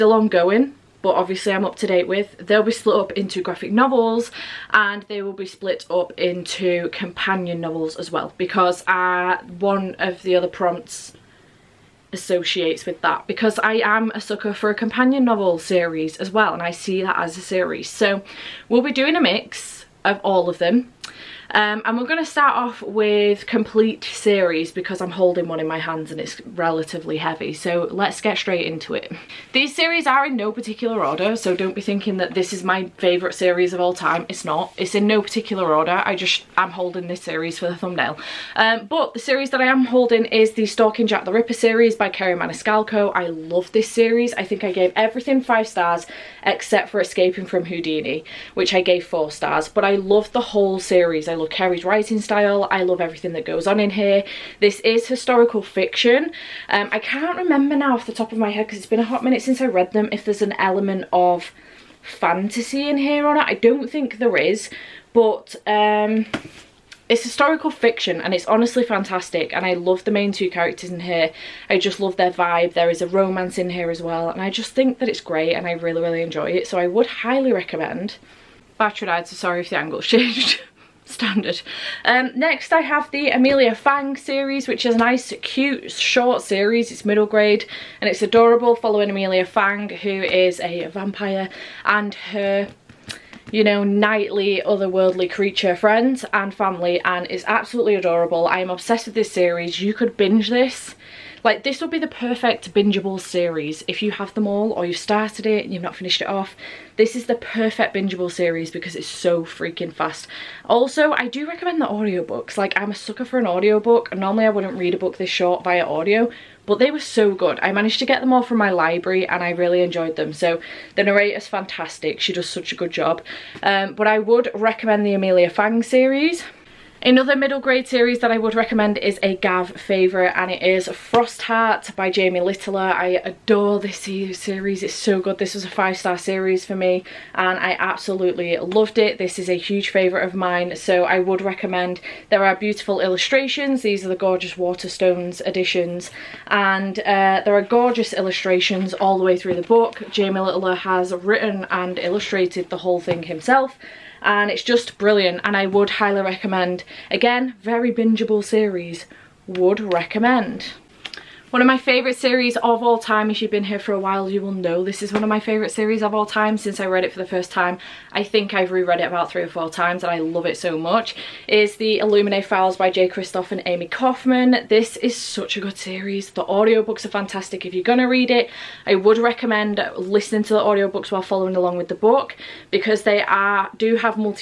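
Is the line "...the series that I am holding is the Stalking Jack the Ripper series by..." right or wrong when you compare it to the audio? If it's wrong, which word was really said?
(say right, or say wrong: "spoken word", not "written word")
right.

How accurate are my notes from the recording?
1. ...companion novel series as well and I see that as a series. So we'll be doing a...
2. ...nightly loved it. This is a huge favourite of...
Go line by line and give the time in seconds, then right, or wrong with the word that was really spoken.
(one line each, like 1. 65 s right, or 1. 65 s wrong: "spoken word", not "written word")
1. 14 s right
2. 137 s wrong: "absolutely", not "nightly".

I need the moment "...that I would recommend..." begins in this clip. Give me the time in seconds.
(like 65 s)
128 s.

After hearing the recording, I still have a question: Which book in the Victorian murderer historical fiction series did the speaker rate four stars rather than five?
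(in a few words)
Escaping from Houdini.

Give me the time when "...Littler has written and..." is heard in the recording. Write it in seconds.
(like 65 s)
150 s.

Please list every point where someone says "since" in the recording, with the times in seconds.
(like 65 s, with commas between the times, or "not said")
59 s, 166 s.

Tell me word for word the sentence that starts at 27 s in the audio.
So let's get straight into it.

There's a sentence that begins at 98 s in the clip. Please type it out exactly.
I am obsessed with this series.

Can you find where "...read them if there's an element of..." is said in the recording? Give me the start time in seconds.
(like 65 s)
59 s.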